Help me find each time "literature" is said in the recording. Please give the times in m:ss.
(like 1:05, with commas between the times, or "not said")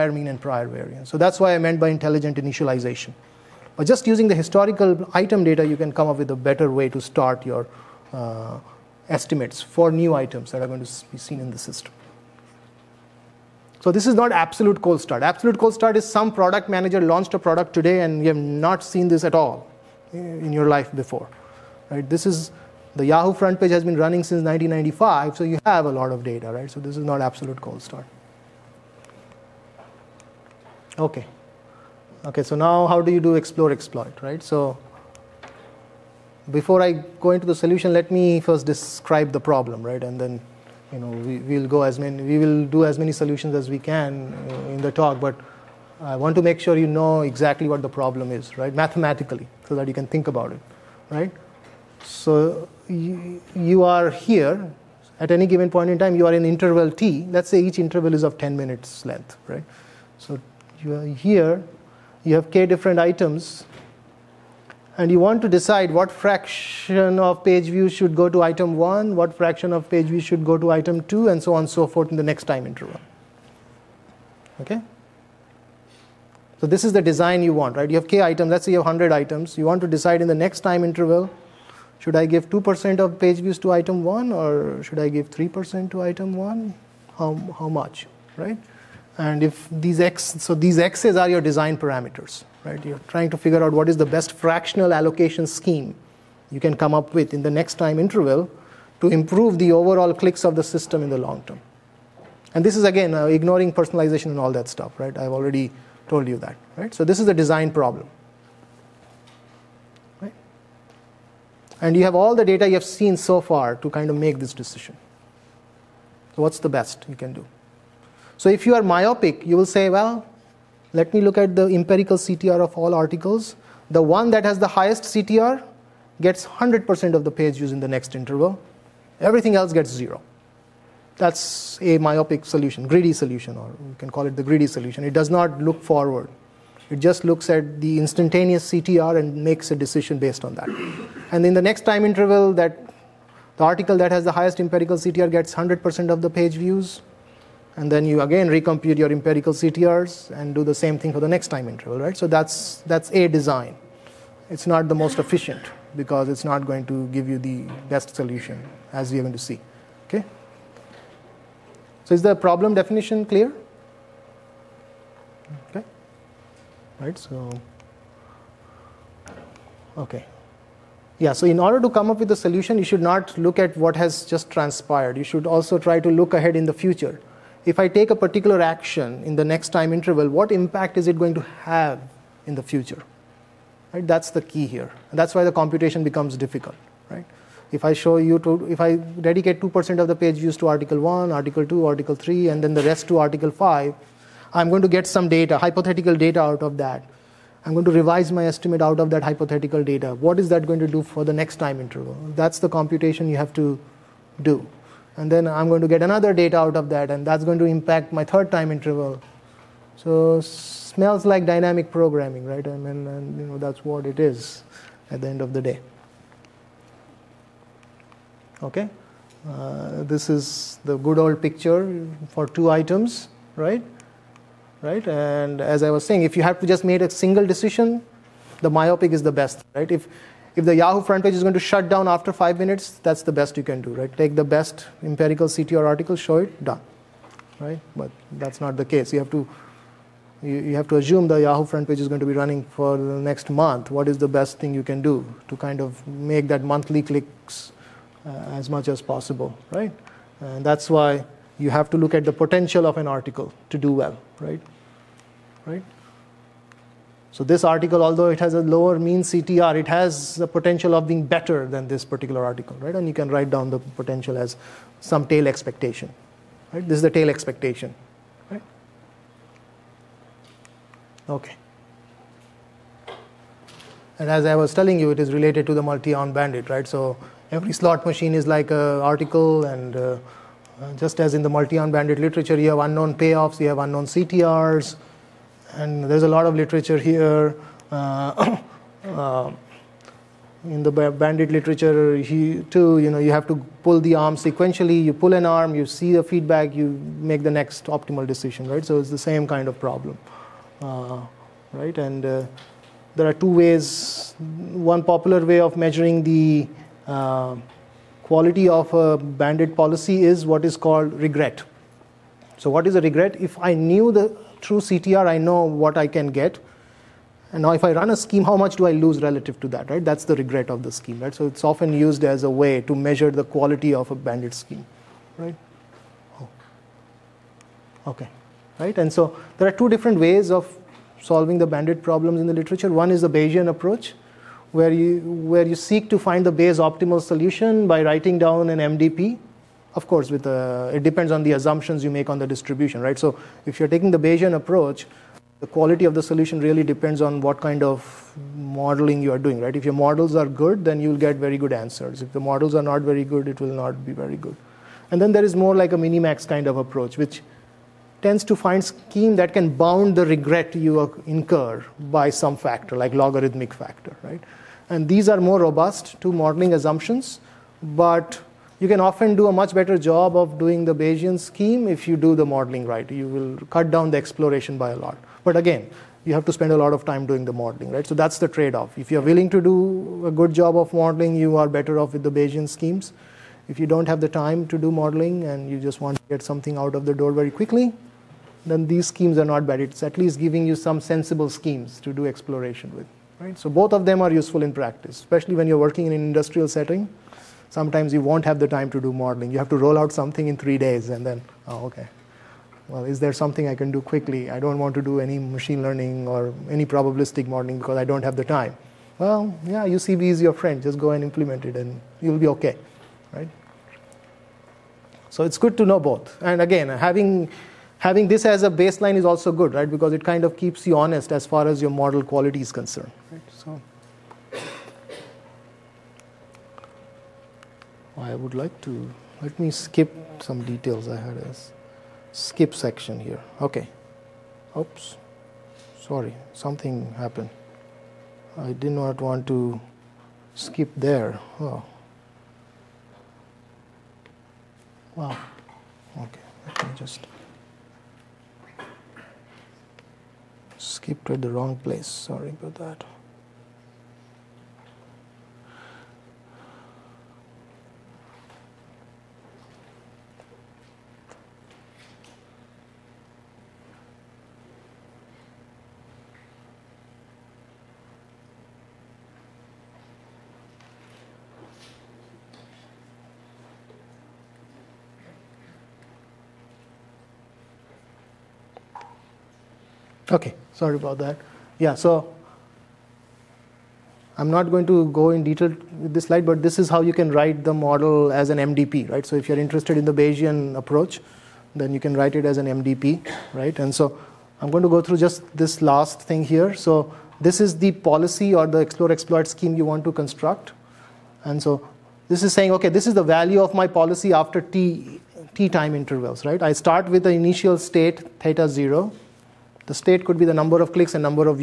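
4:42, 4:46, 4:51, 5:32.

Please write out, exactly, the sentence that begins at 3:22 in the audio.
That's the computation you have to do.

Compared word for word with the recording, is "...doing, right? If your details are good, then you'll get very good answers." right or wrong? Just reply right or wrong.
wrong.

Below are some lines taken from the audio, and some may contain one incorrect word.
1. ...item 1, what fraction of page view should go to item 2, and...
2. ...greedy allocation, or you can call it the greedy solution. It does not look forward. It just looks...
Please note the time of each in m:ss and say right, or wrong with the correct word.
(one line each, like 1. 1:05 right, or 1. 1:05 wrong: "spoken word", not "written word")
1. 1:08 right
2. 2:12 wrong: "solution", not "allocation".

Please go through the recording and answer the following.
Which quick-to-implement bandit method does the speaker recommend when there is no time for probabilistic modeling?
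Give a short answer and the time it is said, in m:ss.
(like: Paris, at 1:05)
UCB, at 6:49.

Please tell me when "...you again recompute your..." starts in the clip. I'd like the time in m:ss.
2:28.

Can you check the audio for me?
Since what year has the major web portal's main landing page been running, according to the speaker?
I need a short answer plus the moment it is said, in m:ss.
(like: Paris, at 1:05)
1995, at 0:24.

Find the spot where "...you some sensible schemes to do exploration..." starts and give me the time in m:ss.
6:30.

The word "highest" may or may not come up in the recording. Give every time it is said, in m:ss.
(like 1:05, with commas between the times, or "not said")
2:04, 2:24.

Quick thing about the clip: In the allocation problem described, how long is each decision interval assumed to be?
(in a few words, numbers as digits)
10 minutes.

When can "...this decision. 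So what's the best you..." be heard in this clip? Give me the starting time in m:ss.
1:54.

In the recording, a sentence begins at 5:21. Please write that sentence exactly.
So, it's often used as a way to measure the quality of a bandit scheme, right?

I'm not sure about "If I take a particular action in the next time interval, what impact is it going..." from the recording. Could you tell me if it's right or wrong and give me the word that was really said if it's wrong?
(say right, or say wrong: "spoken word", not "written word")
right.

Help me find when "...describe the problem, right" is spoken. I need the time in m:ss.
0:38.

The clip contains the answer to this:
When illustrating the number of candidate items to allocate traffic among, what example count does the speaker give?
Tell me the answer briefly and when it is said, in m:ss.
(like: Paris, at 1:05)
100, at 1:18.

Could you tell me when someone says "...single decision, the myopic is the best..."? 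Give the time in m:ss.
3:47.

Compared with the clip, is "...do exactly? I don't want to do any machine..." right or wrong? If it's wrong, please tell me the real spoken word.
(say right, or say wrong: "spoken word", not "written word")
wrong: "quickly", not "exactly".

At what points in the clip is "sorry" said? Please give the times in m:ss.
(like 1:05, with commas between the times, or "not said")
7:16, 7:32, 8:00.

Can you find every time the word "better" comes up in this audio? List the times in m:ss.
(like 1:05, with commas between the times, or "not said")
0:06, 4:21, 6:09, 6:21.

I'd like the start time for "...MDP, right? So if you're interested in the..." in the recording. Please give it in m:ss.
8:08.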